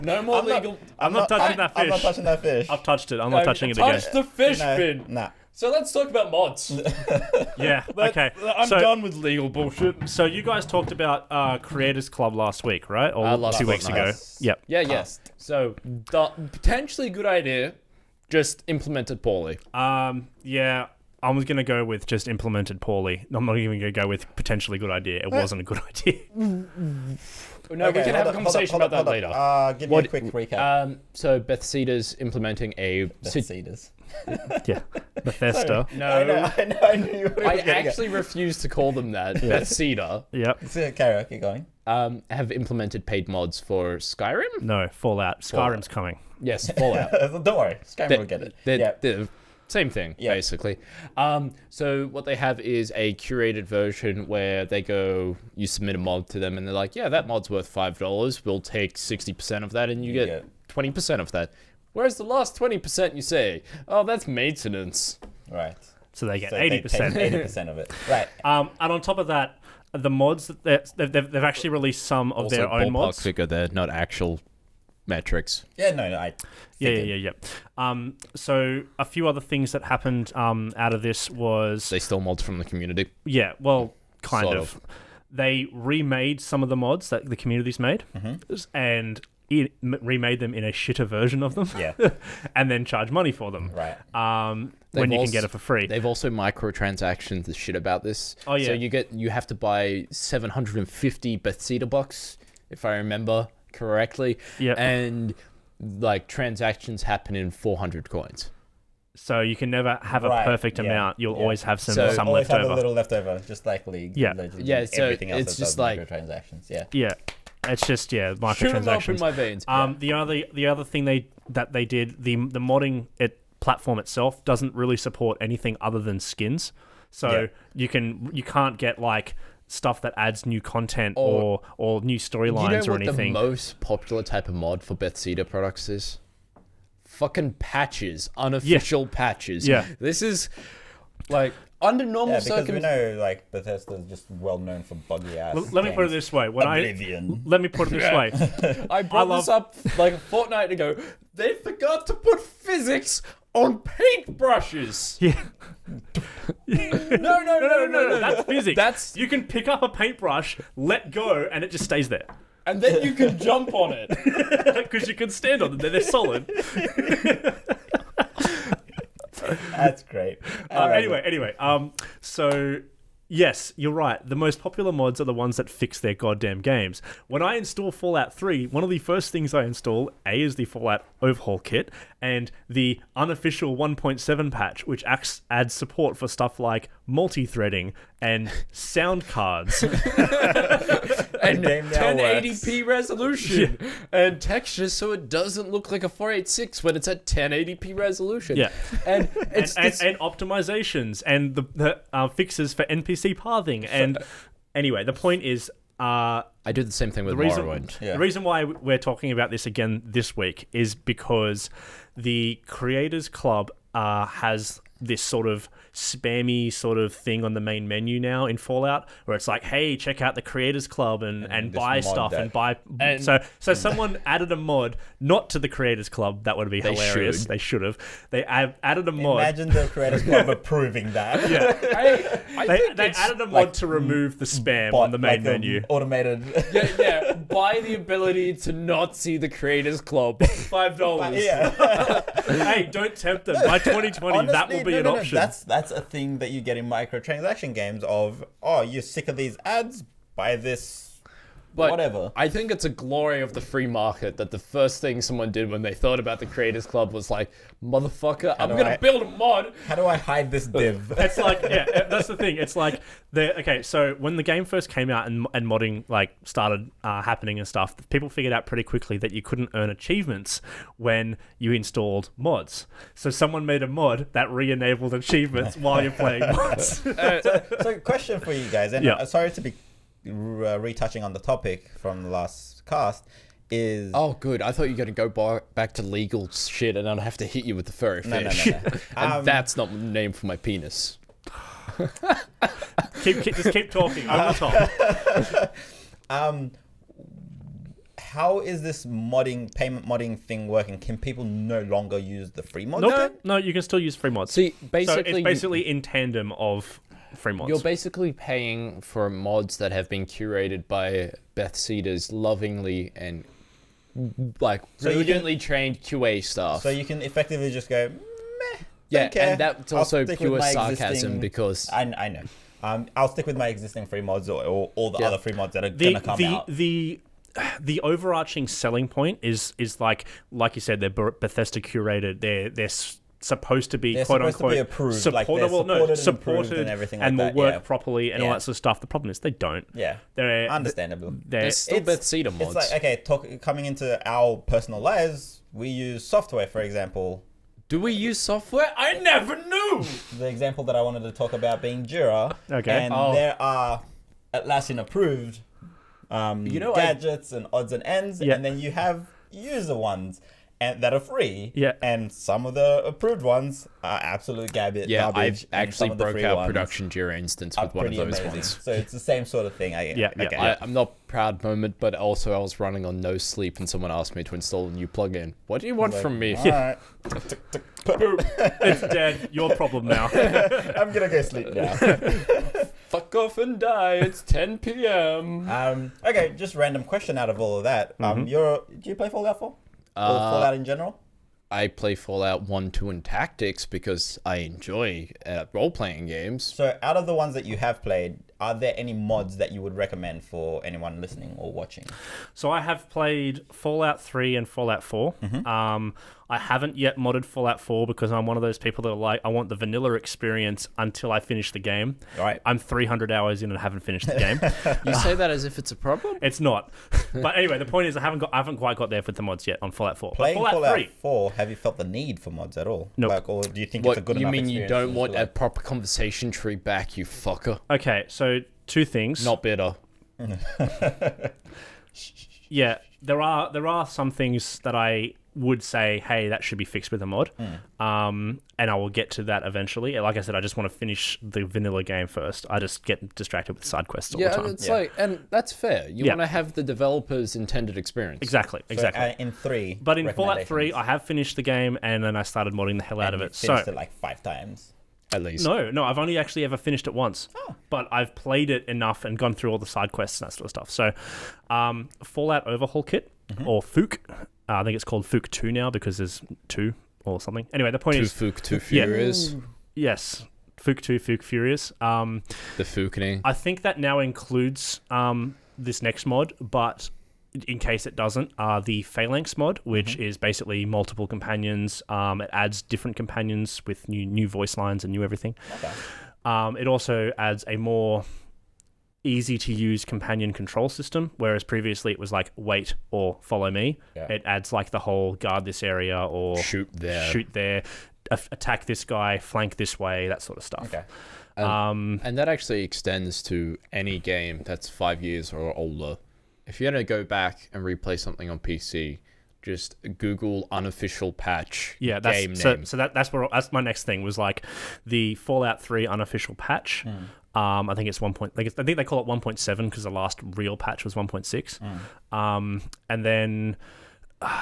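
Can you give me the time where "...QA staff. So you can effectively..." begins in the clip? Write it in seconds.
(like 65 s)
316 s.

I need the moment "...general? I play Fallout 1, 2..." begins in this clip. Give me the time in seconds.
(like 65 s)
390 s.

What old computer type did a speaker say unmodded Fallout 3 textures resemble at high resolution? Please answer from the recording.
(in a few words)
486.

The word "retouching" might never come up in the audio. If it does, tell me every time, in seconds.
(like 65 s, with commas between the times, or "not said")
280 s.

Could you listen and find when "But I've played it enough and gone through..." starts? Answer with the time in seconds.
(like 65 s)
457 s.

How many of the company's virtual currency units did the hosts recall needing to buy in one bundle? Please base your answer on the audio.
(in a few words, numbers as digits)
750.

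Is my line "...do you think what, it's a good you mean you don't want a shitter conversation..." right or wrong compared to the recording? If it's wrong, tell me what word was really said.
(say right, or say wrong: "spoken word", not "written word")
wrong: "proper", not "shitter".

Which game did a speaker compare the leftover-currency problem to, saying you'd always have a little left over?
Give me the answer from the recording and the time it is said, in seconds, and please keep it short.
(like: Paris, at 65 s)
League, at 113 s.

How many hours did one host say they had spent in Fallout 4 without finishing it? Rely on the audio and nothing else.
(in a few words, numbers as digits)
300.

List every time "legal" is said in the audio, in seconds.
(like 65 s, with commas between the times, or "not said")
0 s, 9 s, 286 s.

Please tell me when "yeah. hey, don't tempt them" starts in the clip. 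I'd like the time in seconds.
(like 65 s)
241 s.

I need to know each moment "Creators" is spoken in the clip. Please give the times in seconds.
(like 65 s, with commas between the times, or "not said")
11 s, 212 s, 220 s, 225 s, 229 s, 239 s, 256 s.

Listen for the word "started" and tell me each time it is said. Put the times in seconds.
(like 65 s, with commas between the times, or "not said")
266 s, 452 s.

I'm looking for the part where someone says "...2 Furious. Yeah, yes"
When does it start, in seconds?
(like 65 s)
468 s.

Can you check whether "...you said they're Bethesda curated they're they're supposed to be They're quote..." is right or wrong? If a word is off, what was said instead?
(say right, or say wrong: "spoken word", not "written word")
right.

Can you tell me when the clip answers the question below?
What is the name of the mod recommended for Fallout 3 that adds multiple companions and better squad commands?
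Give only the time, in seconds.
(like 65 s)
479 s.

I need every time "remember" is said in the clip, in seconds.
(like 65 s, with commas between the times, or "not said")
102 s.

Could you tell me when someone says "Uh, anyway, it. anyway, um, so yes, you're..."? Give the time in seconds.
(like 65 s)
170 s.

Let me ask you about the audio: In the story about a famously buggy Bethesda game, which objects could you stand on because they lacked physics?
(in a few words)
paintbrushes.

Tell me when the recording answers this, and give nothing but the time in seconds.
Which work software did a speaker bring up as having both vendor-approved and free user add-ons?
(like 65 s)
352 s.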